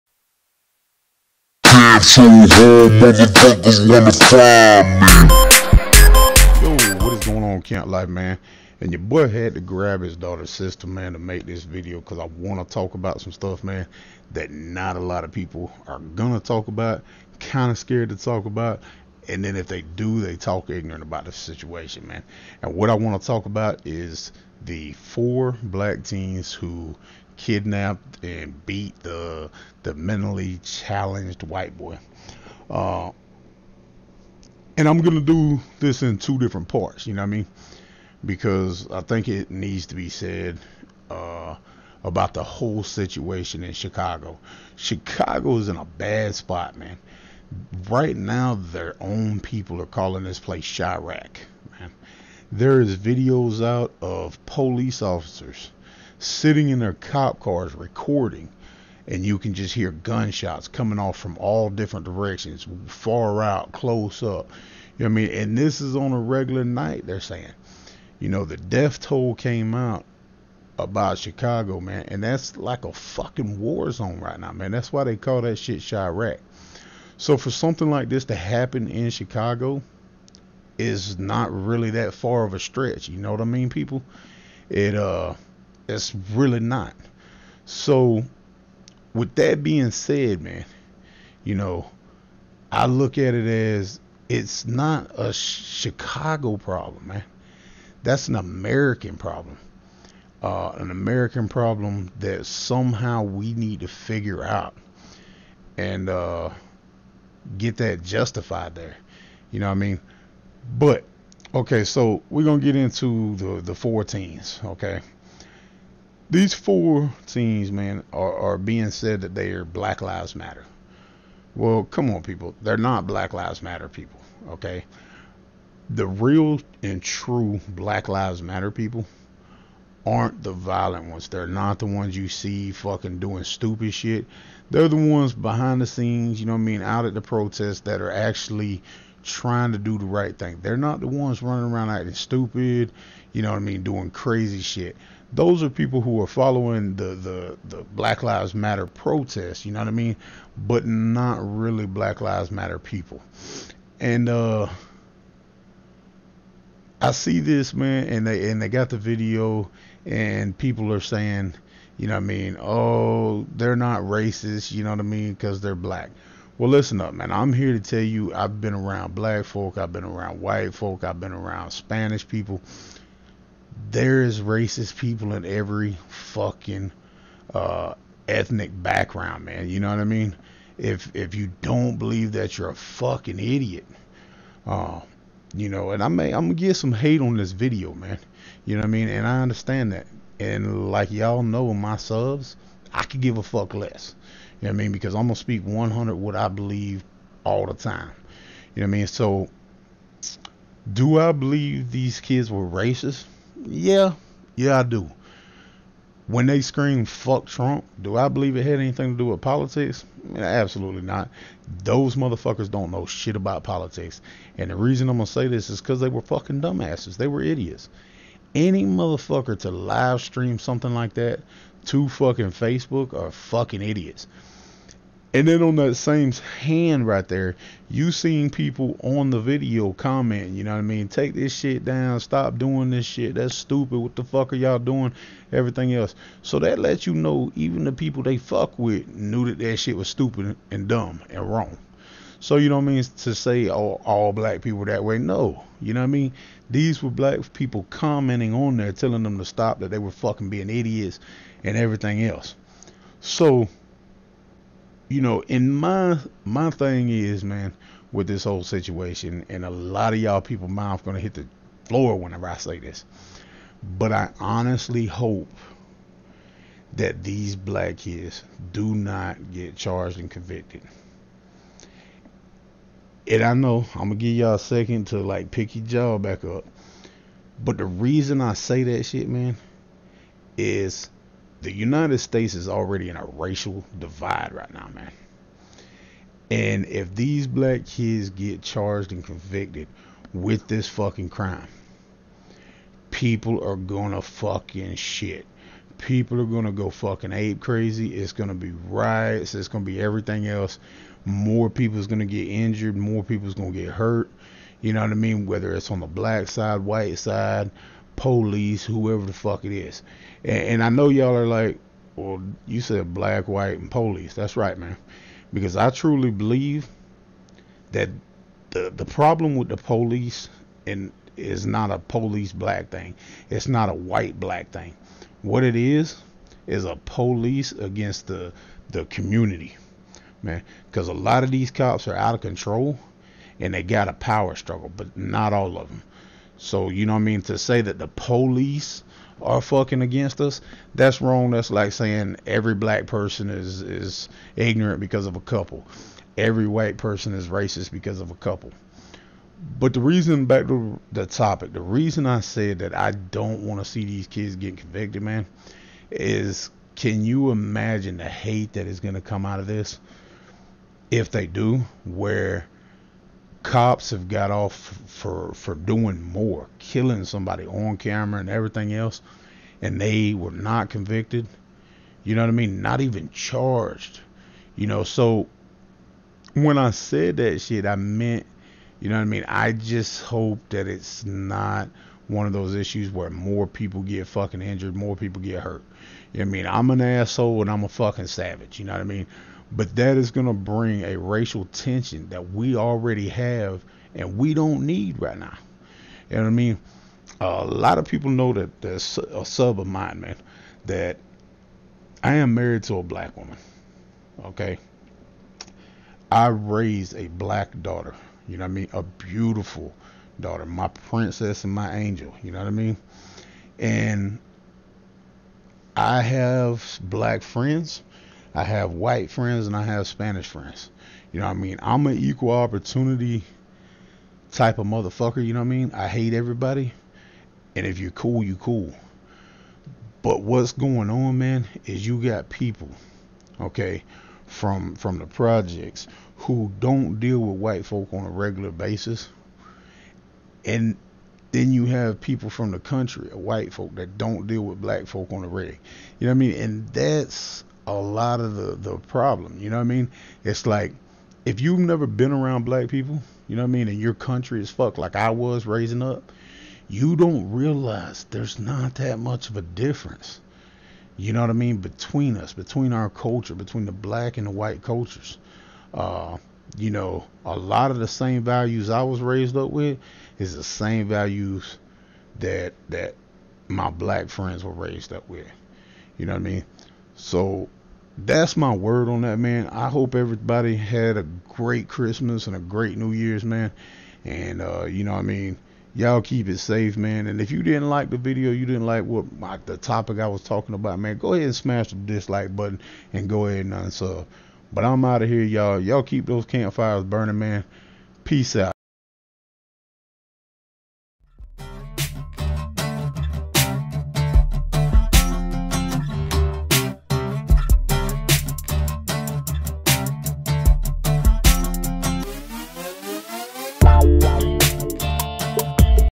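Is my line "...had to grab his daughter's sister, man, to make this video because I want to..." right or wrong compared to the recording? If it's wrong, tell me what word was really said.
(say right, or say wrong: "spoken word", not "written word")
right.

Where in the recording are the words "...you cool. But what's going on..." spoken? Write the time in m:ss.
7:08.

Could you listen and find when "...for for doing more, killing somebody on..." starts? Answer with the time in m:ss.
6:05.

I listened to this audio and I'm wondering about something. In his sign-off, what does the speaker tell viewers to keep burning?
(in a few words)
campfires.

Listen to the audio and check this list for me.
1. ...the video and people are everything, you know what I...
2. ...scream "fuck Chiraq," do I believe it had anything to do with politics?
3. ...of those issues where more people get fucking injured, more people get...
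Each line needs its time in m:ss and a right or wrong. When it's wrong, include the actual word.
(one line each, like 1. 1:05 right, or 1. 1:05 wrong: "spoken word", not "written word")
1. 2:38 wrong: "saying", not "everything"
2. 3:26 wrong: "Trump", not "Chiraq"
3. 6:22 right.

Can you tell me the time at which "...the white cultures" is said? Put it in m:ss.
7:44.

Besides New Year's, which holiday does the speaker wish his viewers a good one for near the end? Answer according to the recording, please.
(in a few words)
Christmas.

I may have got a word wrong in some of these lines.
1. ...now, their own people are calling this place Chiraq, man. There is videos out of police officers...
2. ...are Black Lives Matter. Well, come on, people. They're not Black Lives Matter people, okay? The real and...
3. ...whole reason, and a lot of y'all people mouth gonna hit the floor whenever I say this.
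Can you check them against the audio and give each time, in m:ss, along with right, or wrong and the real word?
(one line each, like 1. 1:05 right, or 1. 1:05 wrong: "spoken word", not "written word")
1. 0:48 right
2. 1:59 right
3. 4:18 wrong: "situation", not "reason".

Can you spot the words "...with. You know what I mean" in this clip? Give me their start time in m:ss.
7:55.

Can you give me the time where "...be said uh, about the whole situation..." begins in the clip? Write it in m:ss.
0:39.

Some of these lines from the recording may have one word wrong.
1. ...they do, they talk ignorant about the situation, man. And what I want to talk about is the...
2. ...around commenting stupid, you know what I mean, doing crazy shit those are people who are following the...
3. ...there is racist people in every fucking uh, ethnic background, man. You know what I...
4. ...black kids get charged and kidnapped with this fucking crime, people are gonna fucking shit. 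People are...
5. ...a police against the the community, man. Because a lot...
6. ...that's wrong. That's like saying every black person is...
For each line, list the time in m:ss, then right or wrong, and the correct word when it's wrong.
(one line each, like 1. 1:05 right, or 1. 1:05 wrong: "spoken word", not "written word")
1. 0:19 right
2. 2:21 wrong: "acting", not "commenting"
3. 2:53 right
4. 4:47 wrong: "convicted", not "kidnapped"
5. 5:26 right
6. 5:40 right.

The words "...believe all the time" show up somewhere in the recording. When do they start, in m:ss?
3:16.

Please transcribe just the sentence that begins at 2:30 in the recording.
But not really Black Lives Matter people.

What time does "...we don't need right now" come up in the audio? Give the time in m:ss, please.
6:34.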